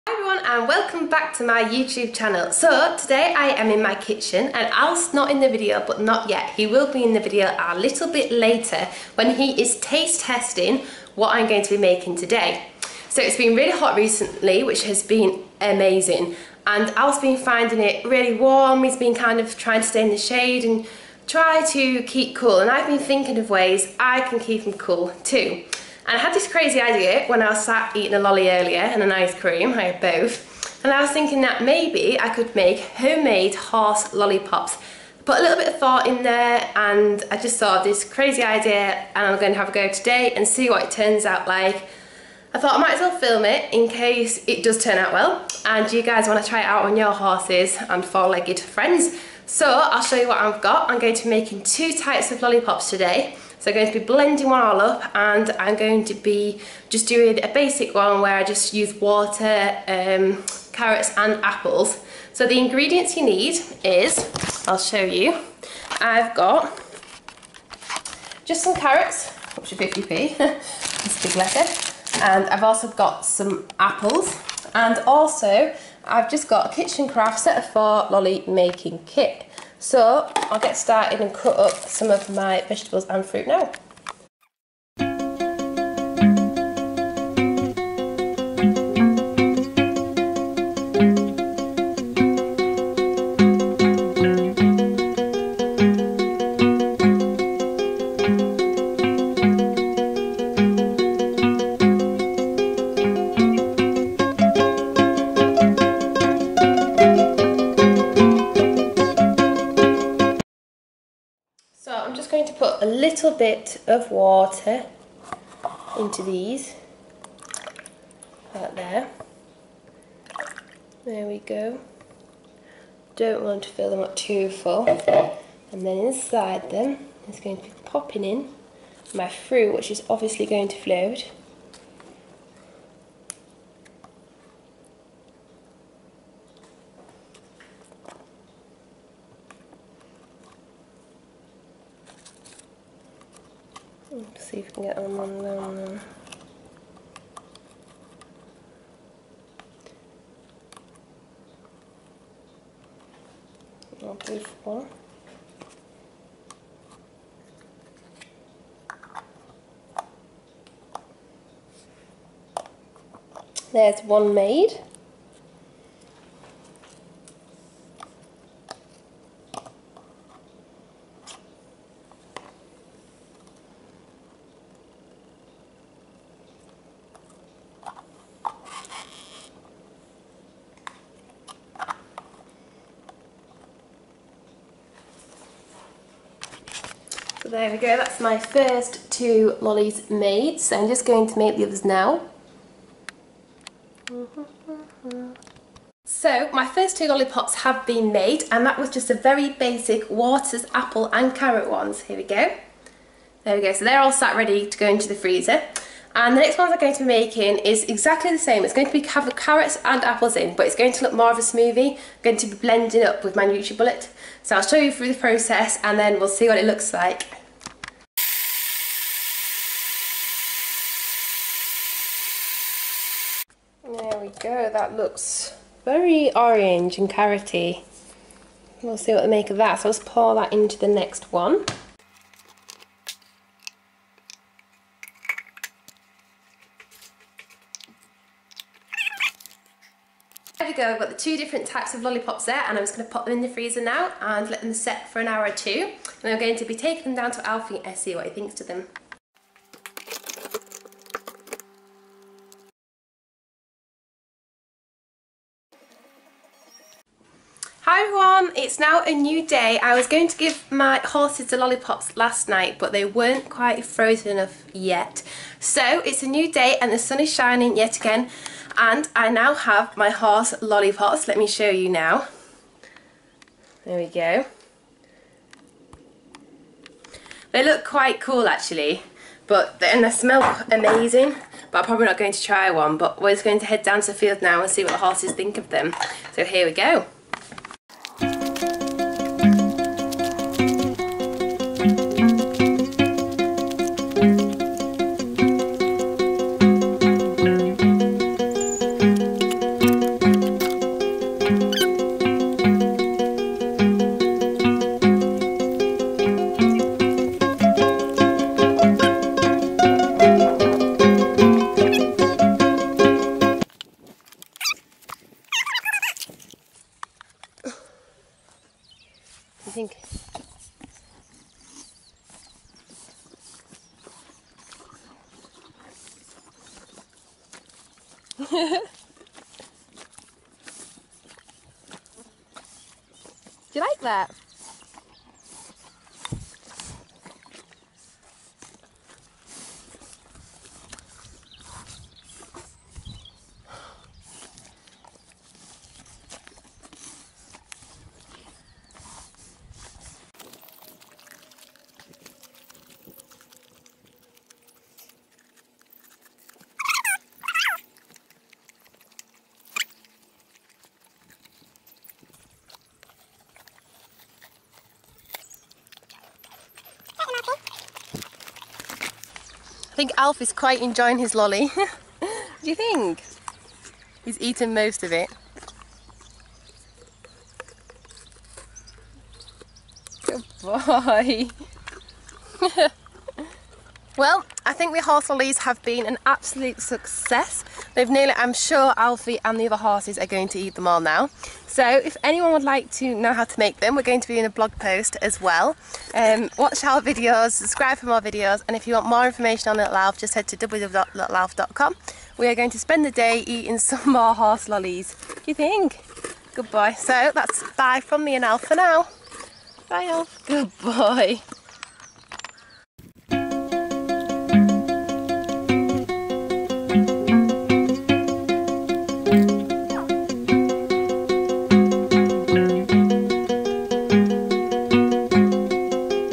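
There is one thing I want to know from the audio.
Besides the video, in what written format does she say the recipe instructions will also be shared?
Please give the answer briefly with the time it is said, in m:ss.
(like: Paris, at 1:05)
blog post, at 6:34.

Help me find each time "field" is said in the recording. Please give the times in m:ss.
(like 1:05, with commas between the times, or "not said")
4:44.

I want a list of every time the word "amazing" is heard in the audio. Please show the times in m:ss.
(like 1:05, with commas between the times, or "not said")
0:15, 4:40.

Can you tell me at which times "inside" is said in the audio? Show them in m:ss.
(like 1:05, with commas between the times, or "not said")
2:06.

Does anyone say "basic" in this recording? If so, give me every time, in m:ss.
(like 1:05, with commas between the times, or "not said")
0:57, 3:19.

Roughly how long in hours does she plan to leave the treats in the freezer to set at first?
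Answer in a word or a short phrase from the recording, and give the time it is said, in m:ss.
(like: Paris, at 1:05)
an hour or two, at 4:05.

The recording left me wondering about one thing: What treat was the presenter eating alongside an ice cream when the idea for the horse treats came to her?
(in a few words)
a lolly.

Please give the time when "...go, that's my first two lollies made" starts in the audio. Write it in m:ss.
3:07.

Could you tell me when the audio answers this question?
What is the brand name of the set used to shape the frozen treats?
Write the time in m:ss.
1:16.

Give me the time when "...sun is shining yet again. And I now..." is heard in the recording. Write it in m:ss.
4:26.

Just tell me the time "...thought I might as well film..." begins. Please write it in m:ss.
0:42.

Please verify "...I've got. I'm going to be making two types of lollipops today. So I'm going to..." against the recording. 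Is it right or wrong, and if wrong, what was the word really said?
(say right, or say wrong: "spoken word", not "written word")
right.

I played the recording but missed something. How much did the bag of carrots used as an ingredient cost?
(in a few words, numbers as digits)
50p.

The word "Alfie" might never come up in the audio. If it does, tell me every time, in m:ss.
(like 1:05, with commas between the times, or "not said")
4:07, 6:28.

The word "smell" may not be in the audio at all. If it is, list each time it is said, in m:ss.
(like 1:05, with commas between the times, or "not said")
4:40.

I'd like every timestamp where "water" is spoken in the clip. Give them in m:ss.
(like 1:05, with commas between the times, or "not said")
0:58, 1:54, 3:20.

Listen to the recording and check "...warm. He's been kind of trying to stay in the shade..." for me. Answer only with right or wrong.
right.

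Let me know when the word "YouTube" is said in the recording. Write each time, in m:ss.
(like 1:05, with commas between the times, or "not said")
0:01.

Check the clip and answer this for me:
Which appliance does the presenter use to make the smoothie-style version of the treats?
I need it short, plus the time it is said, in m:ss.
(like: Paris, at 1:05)
NutriBullet, at 3:33.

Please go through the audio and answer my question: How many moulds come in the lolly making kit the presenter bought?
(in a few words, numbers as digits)
4.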